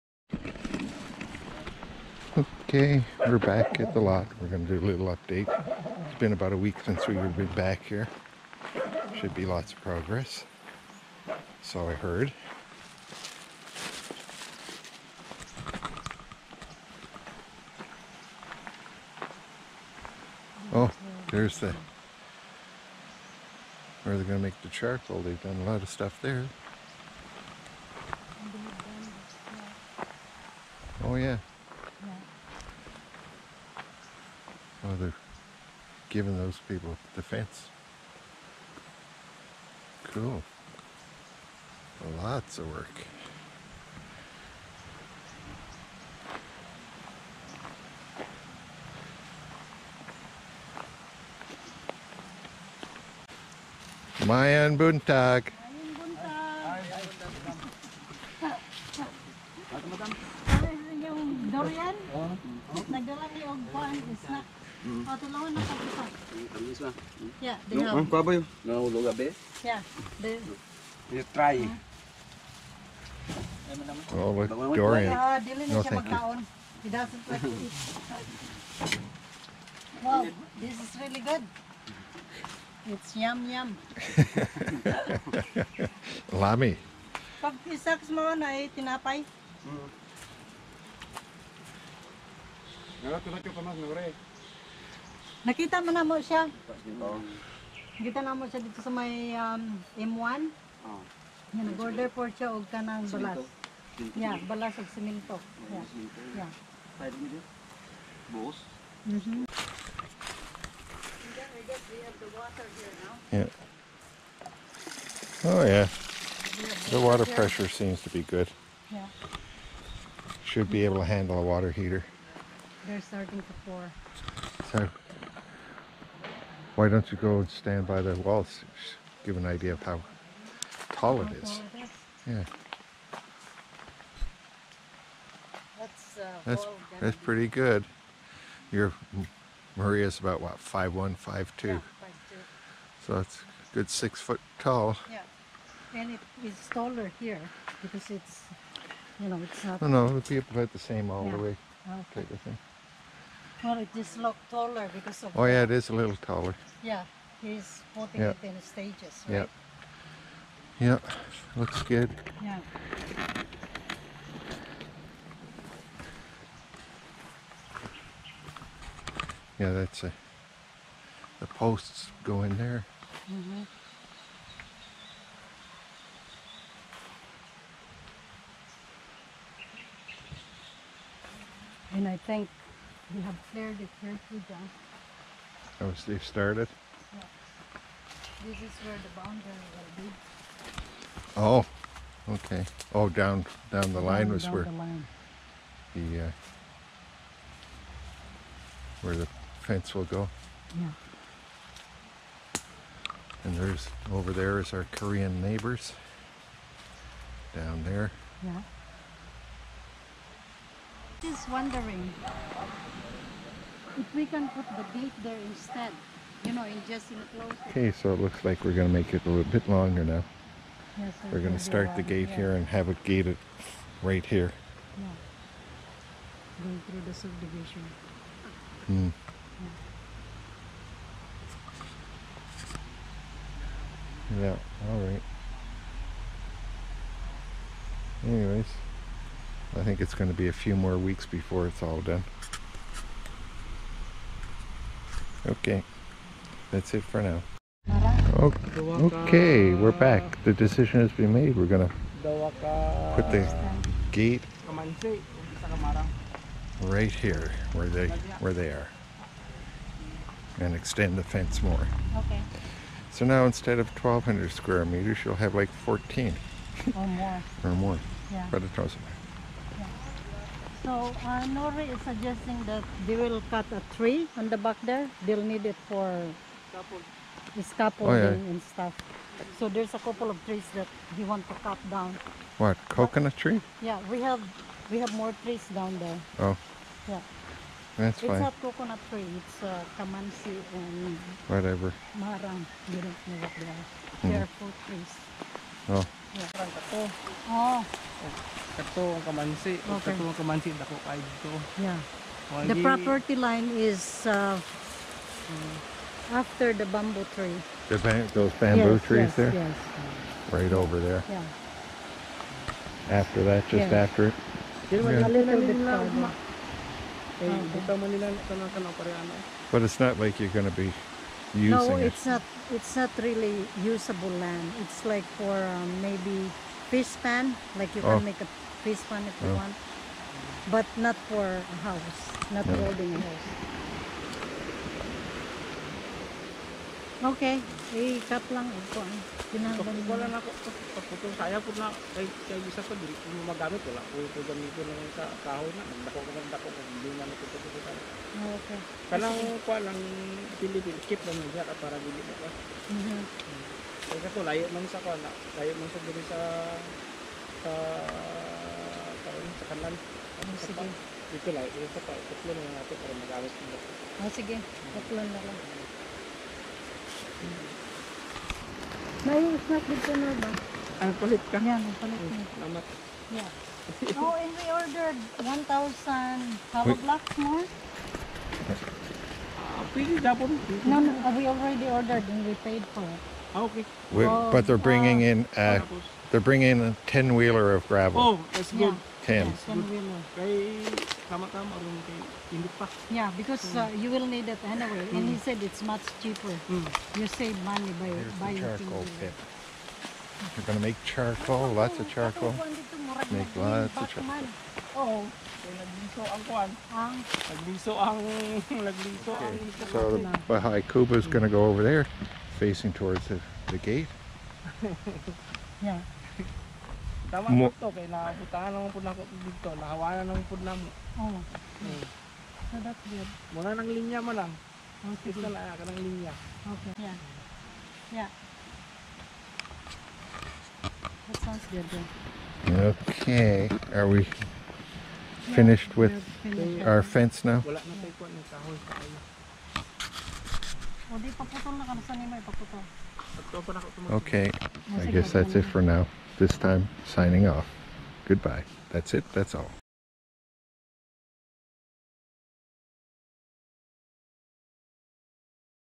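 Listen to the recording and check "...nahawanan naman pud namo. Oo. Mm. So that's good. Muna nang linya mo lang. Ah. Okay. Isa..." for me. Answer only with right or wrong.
right.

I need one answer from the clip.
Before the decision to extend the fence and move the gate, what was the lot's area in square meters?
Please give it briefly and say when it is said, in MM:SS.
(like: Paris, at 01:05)
1,200 square meters, at 04:23.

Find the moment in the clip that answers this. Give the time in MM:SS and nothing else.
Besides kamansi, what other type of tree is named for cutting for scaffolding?
04:52.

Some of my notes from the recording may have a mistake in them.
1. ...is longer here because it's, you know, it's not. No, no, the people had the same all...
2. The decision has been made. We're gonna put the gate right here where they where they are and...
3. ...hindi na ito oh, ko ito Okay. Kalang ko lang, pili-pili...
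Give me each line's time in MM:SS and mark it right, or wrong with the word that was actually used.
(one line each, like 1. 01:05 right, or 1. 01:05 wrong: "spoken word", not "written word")
1. 02:26 wrong: "taller", not "longer"
2. 04:10 right
3. 05:46 right.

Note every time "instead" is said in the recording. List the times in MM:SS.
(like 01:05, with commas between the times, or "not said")
03:35, 04:23.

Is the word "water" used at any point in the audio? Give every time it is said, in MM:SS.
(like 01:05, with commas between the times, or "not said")
01:57, 02:01.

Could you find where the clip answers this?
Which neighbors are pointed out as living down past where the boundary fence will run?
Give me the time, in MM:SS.
03:24.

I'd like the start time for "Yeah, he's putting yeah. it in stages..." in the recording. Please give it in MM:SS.
02:36.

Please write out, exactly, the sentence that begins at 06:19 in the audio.
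Ah, no, no, uh, we already ordered and we paid for it.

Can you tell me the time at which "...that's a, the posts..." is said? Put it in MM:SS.
02:49.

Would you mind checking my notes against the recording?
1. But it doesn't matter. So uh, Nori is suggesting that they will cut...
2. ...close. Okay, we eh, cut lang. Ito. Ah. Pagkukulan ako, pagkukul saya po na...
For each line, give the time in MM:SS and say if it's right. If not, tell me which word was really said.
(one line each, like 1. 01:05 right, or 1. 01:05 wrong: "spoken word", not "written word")
1. 04:28 right
2. 05:33 wrong: "house", not "close".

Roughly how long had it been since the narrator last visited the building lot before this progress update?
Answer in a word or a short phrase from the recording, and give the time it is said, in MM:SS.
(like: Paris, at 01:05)
About a week, at 00:06.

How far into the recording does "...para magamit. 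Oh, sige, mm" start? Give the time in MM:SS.
06:03.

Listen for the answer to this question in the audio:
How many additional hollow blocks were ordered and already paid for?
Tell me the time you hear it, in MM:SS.
06:15.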